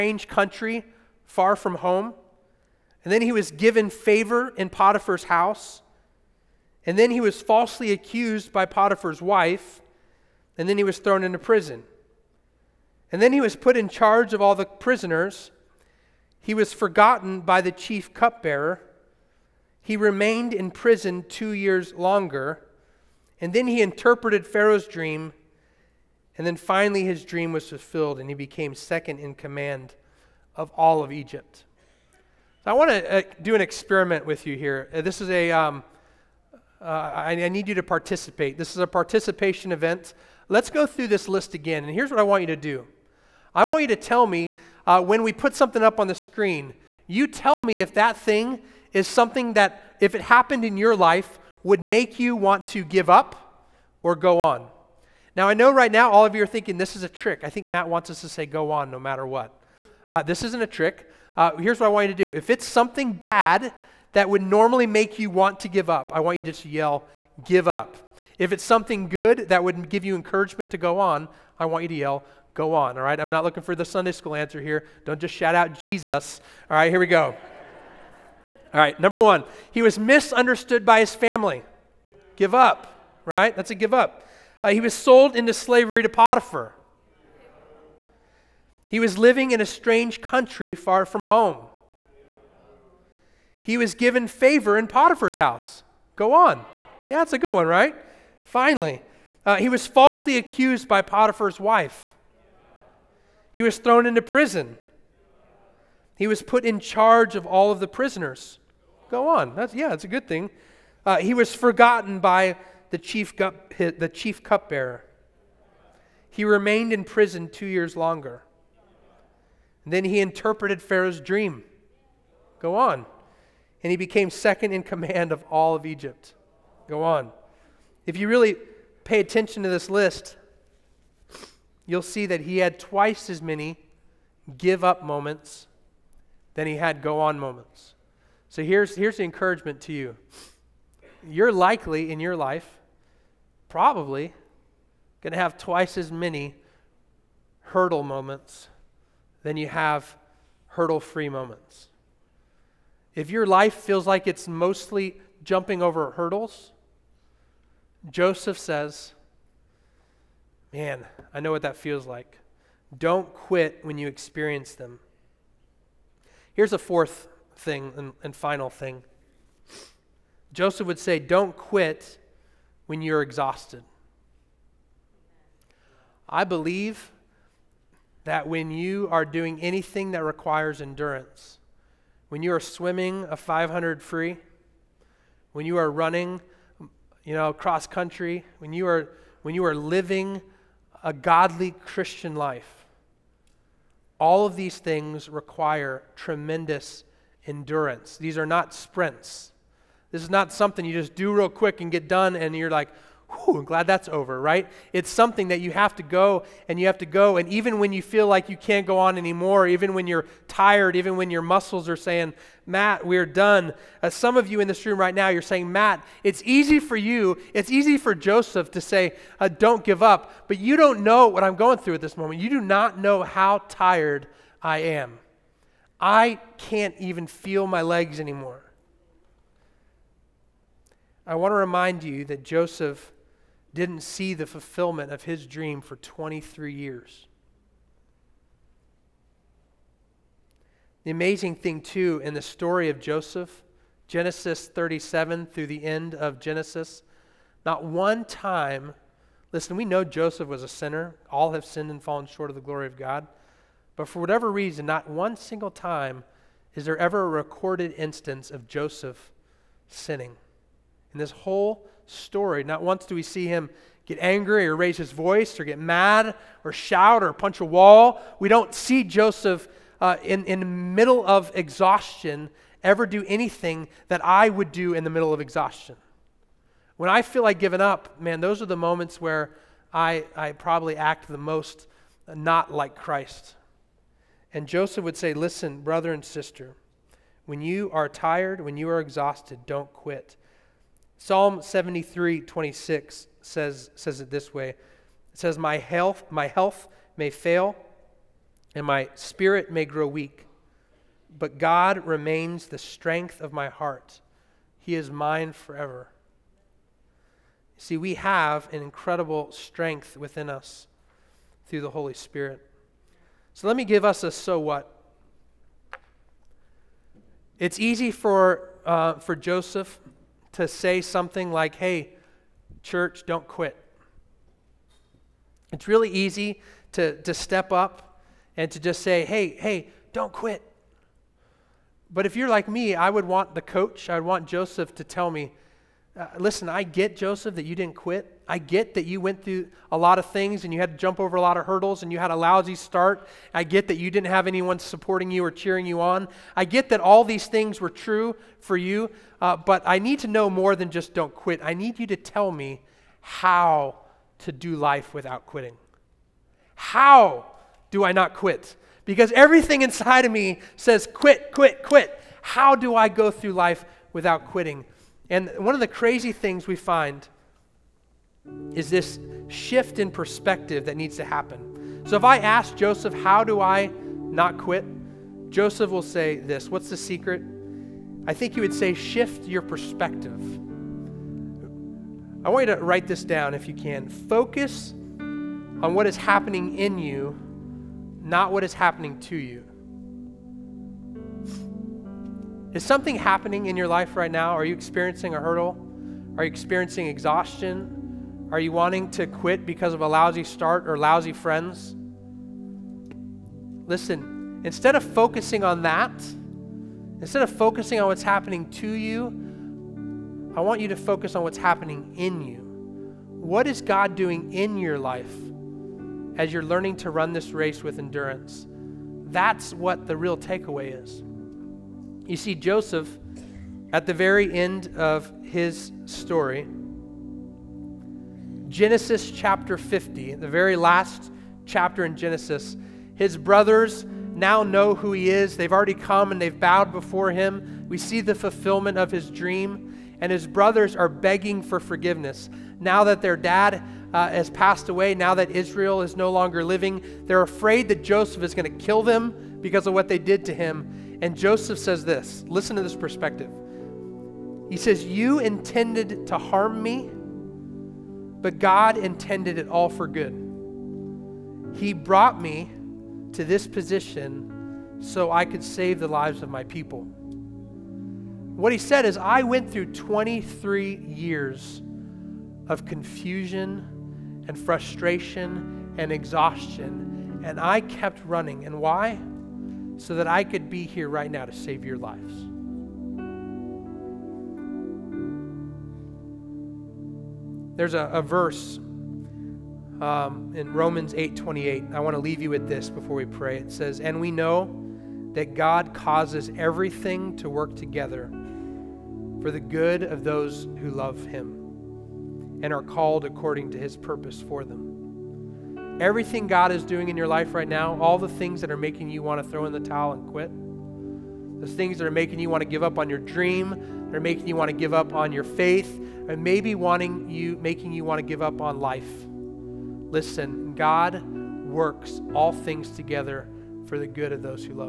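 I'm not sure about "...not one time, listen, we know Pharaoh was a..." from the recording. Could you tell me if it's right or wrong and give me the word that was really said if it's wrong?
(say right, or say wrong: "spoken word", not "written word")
wrong: "Joseph", not "Pharaoh".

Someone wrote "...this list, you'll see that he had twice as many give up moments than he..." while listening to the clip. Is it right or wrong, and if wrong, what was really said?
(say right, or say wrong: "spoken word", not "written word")
right.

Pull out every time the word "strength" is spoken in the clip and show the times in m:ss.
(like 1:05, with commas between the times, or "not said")
5:02, 5:09.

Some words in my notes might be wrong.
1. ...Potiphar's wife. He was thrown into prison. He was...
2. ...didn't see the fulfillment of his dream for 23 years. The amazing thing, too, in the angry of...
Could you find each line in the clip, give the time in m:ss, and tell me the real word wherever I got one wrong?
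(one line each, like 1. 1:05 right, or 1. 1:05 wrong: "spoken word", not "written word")
1. 1:41 right
2. 3:53 wrong: "story", not "angry".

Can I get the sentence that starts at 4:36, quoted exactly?
When I feel like giving up, man, those are the moments where I, I probably act the most not like Christ.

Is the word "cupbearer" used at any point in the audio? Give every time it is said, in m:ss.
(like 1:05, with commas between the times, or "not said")
0:18, 1:54.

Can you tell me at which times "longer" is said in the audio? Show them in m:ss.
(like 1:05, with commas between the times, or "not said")
0:21, 1:57, 7:26.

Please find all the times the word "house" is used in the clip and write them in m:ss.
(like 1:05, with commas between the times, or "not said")
0:05, 1:35.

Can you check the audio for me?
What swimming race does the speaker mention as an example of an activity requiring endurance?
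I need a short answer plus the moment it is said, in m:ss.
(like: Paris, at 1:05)
500 free, at 3:03.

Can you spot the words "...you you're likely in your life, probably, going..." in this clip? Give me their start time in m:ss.
2:19.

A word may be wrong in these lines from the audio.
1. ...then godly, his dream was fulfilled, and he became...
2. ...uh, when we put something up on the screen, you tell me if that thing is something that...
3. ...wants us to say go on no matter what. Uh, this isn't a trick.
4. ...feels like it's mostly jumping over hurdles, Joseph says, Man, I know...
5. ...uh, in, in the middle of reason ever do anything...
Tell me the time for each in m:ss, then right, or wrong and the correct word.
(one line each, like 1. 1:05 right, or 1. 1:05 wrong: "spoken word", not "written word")
1. 0:26 wrong: "finally", not "godly"
2. 0:44 right
3. 0:57 right
4. 2:33 right
5. 4:29 wrong: "exhaustion", not "reason".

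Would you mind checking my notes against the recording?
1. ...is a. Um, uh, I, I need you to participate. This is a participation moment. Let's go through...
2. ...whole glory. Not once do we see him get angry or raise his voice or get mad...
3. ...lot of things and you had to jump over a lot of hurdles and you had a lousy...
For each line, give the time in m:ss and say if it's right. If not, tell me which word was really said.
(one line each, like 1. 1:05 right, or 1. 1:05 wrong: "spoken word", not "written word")
1. 0:35 wrong: "event", not "moment"
2. 4:21 wrong: "story", not "glory"
3. 5:39 right.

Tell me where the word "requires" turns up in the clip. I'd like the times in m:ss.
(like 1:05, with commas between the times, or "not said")
3:00, 3:15.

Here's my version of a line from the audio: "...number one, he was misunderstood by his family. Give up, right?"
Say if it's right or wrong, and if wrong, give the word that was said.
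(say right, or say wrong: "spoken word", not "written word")
right.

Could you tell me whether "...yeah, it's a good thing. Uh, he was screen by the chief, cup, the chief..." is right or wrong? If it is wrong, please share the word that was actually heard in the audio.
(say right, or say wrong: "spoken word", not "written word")
wrong: "forgotten", not "screen".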